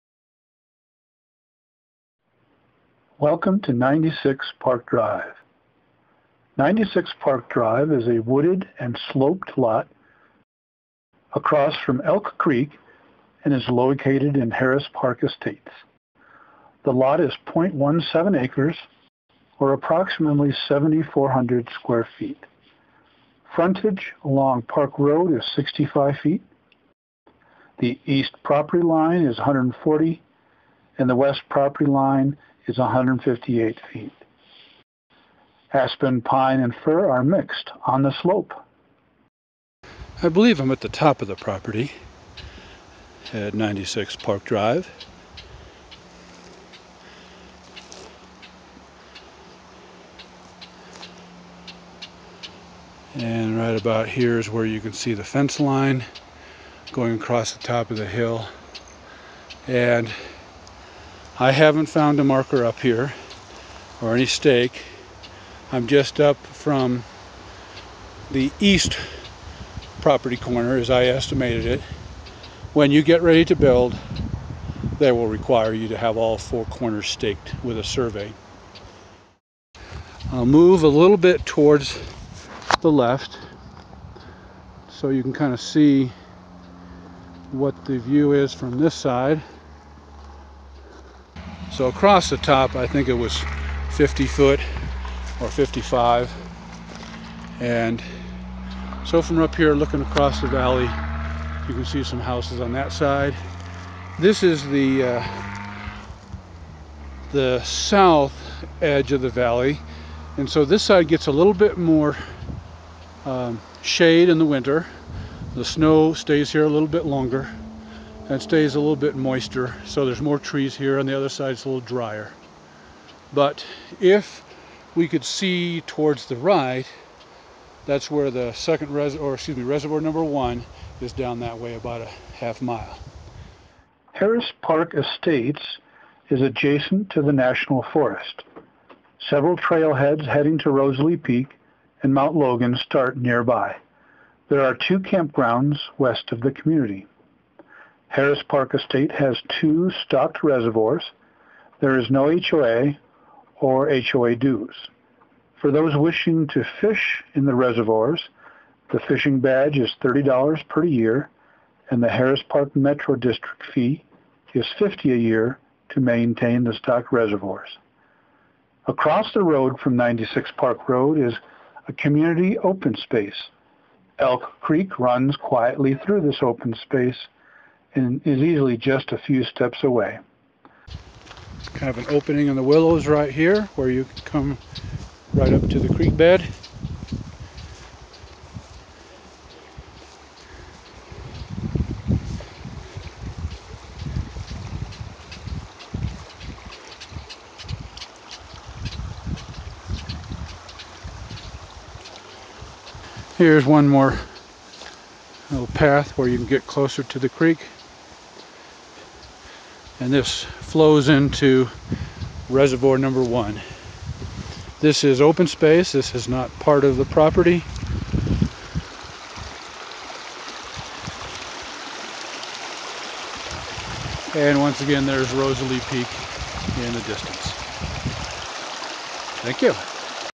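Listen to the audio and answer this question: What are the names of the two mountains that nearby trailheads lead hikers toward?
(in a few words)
Rosalie Peak and Mount Logan.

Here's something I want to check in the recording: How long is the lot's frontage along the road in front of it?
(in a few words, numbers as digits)
65 feet.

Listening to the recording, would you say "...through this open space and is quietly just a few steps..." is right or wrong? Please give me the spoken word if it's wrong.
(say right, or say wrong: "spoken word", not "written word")
wrong: "easily", not "quietly".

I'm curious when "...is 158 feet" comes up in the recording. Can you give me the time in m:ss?
0:32.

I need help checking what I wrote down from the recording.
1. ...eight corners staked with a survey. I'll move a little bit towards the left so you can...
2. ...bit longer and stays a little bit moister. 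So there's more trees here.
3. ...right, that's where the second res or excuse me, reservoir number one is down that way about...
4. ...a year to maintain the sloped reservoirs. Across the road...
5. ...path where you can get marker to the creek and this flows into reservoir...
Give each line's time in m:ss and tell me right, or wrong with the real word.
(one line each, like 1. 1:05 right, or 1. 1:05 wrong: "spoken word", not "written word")
1. 1:16 wrong: "four", not "eight"
2. 1:56 right
3. 2:06 right
4. 2:45 wrong: "stocked", not "sloped"
5. 3:25 wrong: "closer", not "marker".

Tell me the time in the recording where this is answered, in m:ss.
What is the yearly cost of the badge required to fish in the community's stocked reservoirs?
2:40.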